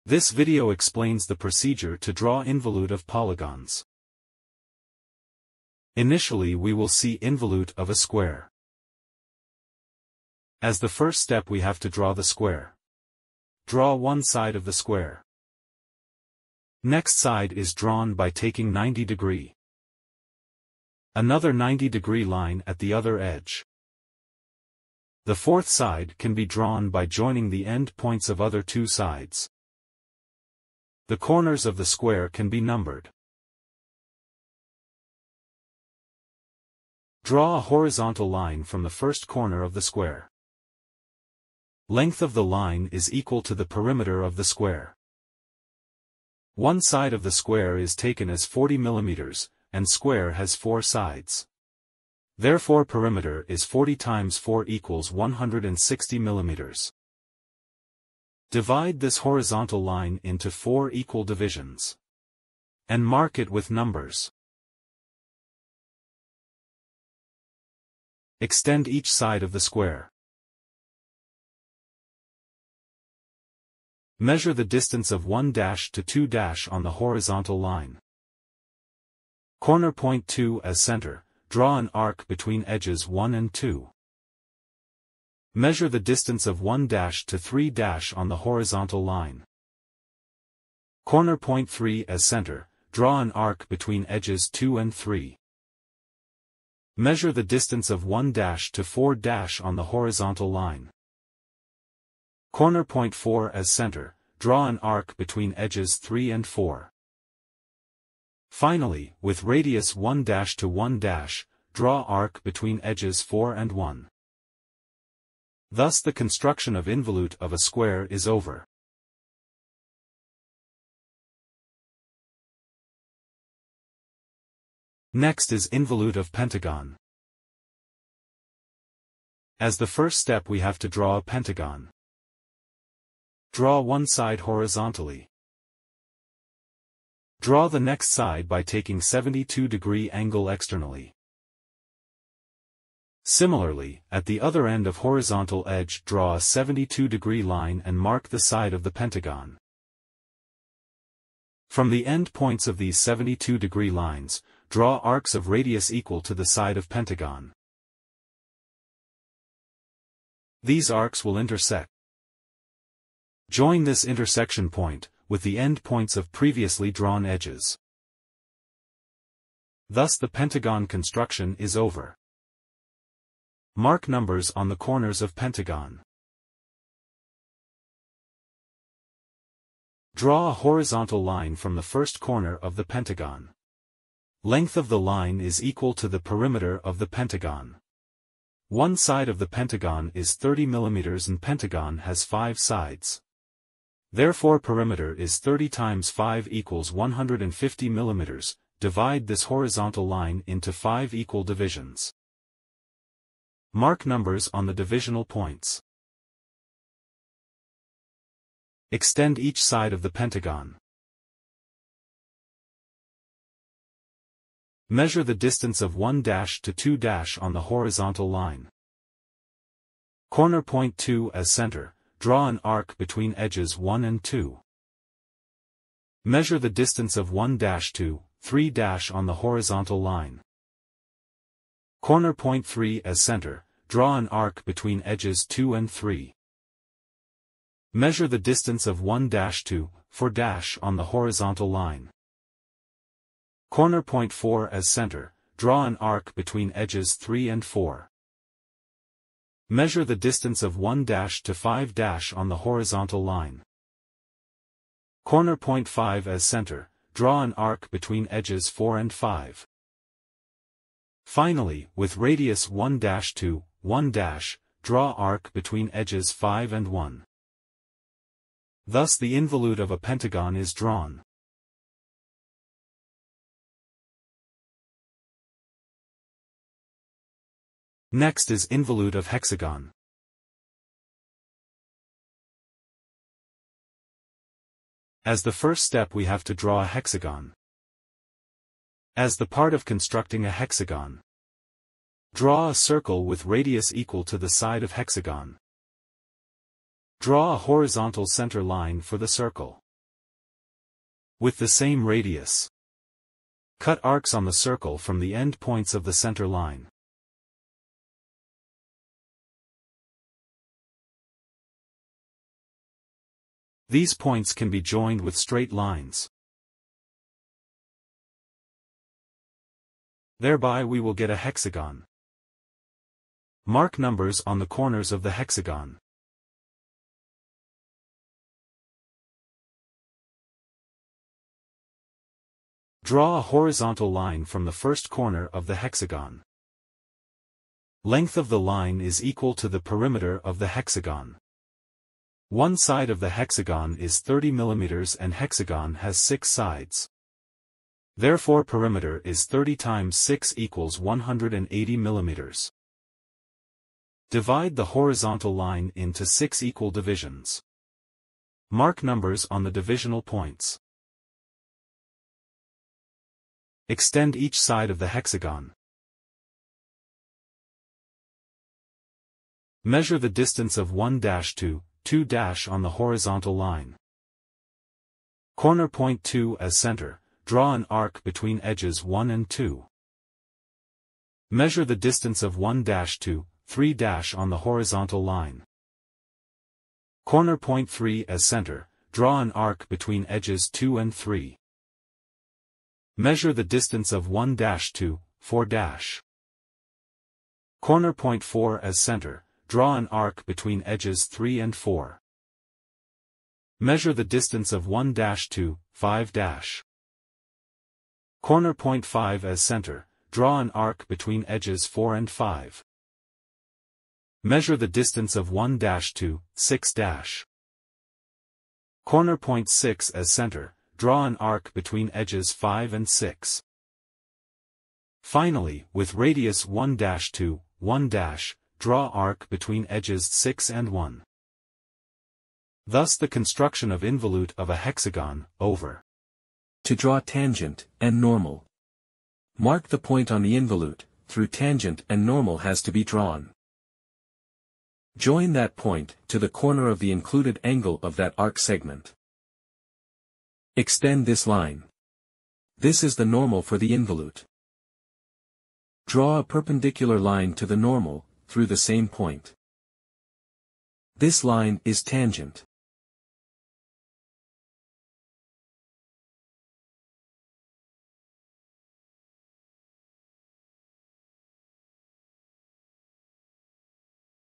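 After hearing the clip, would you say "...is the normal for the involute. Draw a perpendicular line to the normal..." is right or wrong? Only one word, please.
right.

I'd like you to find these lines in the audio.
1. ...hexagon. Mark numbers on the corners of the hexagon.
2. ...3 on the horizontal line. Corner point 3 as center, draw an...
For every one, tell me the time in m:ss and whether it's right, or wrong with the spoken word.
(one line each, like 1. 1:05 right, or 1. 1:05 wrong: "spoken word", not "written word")
1. 5:21 right
2. 6:23 right.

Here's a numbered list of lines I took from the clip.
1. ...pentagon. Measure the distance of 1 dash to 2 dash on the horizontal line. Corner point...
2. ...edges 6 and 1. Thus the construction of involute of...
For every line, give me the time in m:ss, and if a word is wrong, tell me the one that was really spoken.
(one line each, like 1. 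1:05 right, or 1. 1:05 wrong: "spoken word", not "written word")
1. 3:30 right
2. 7:09 right.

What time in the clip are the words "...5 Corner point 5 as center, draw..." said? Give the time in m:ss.
6:45.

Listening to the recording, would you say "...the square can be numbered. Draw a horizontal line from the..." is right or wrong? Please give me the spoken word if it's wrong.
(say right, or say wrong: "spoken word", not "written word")
right.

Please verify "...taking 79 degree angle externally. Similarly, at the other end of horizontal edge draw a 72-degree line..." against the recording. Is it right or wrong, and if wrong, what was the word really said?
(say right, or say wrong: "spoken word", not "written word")
wrong: "72", not "79".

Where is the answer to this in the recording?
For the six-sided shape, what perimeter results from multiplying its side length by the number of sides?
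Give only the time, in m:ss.
5:50.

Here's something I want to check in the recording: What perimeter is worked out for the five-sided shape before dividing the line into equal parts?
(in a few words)
150 mm.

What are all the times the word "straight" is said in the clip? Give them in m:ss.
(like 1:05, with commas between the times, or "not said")
5:15.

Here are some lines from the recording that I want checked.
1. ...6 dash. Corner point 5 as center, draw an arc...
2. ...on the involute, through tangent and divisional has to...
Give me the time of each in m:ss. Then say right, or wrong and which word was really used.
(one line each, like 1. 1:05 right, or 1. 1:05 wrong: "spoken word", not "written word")
1. 6:56 wrong: "6", not "5"
2. 7:20 wrong: "normal", not "divisional".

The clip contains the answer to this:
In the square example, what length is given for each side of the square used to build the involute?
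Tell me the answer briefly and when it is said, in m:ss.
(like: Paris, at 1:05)
40 mm, at 0:48.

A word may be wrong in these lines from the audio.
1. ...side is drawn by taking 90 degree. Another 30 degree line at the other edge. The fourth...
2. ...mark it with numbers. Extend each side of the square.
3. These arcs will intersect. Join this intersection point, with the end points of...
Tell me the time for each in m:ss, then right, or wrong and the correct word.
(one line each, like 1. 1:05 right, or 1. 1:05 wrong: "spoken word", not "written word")
1. 0:17 wrong: "90", not "30"
2. 1:03 right
3. 2:40 right.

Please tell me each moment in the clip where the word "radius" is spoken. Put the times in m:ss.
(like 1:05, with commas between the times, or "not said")
1:49, 2:35, 4:22, 4:53, 5:02, 7:06.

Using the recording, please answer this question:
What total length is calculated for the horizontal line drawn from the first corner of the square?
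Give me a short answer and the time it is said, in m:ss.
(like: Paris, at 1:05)
160 mm, at 0:55.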